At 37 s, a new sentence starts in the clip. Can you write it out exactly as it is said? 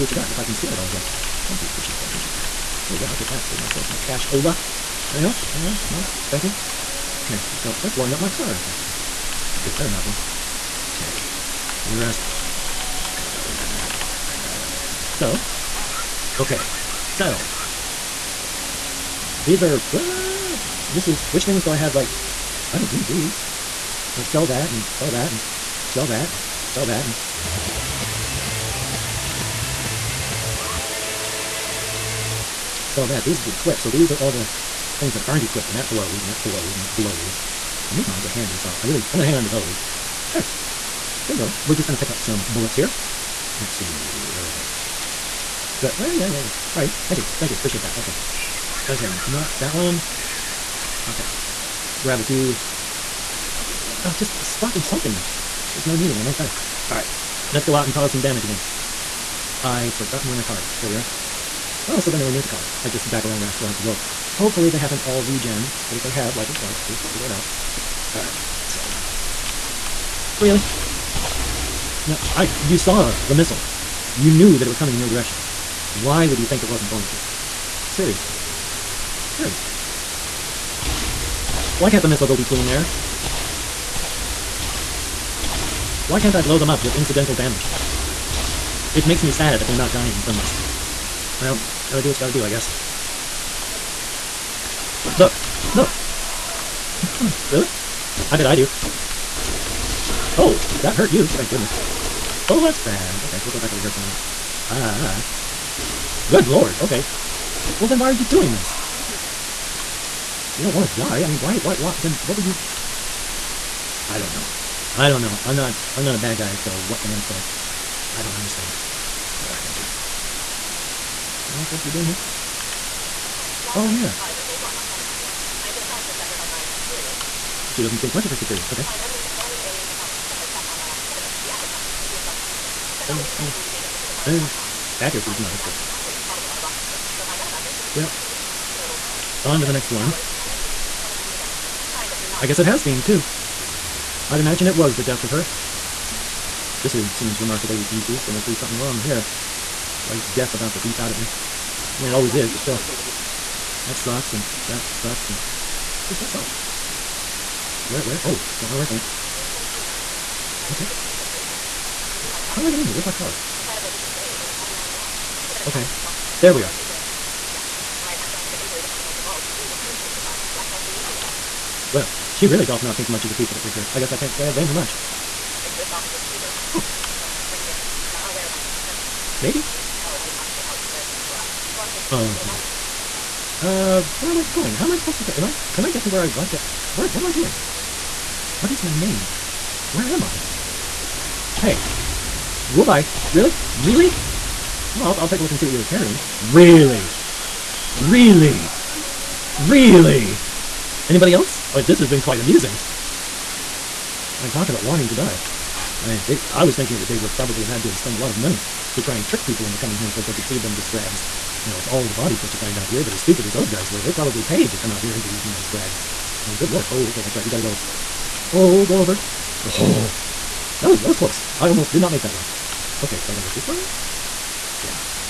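Grenade mods are handy, so I really, I'm going to hang on to those.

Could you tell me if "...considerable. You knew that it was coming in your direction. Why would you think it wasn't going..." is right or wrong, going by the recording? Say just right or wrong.
wrong.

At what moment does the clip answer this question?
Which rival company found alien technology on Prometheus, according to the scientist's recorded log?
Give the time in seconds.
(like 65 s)
131 s.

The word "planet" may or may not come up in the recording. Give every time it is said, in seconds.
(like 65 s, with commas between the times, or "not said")
124 s, 141 s, 163 s.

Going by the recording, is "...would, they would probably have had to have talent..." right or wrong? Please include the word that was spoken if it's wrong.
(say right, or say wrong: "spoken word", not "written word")
wrong: "spent", not "talent".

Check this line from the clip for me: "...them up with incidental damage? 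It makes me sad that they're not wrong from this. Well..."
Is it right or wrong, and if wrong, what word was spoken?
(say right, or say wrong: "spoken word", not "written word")
wrong: "dying", not "wrong".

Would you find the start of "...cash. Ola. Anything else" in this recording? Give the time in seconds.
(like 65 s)
4 s.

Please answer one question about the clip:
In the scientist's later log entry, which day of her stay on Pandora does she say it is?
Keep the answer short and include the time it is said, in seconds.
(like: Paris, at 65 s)
Day 43, at 159 s.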